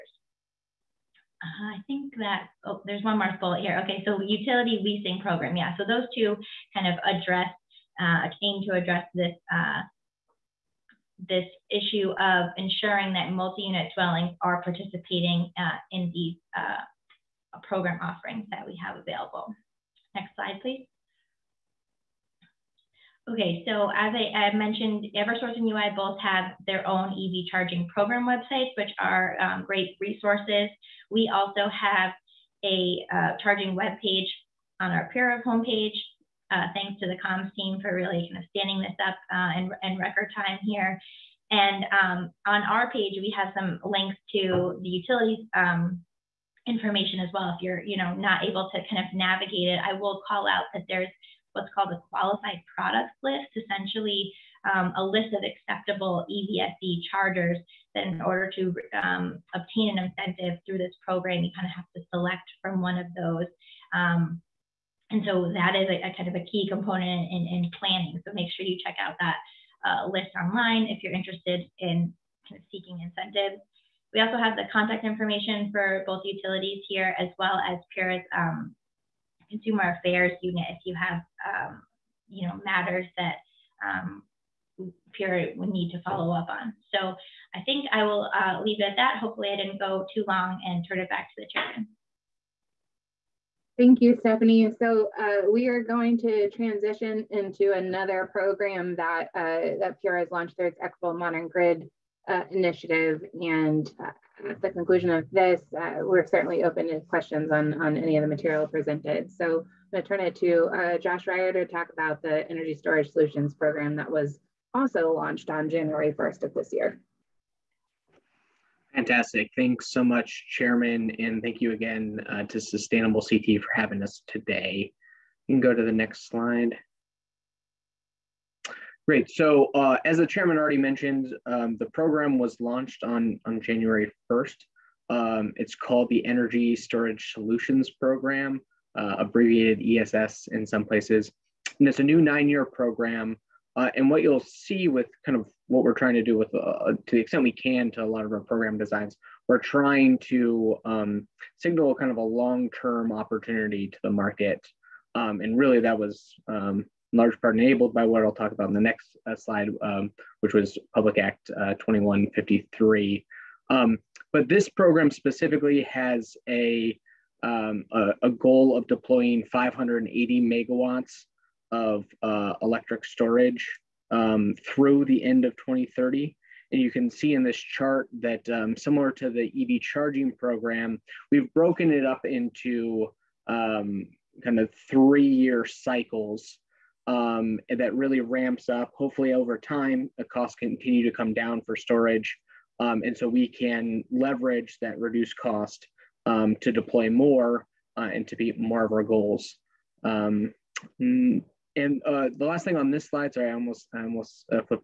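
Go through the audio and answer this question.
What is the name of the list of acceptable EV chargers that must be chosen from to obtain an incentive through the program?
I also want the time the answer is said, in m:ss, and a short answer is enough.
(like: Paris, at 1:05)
qualified product list, at 0:52.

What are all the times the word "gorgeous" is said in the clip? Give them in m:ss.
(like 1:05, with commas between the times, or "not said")
not said.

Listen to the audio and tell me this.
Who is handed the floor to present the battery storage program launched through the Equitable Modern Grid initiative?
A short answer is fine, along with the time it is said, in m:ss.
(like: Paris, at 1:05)
Josh Ryer, at 1:50.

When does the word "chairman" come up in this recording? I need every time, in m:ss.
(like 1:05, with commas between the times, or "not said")
1:31, 2:00, 2:10.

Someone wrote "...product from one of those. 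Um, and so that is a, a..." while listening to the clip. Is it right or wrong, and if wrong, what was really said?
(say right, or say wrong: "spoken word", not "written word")
wrong: "select", not "product".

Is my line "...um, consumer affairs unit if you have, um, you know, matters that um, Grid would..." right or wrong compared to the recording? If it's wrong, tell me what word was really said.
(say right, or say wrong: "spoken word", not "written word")
wrong: "PURA", not "Grid".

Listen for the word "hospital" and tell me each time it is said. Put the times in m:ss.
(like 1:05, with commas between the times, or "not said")
not said.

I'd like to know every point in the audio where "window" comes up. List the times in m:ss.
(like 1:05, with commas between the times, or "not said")
not said.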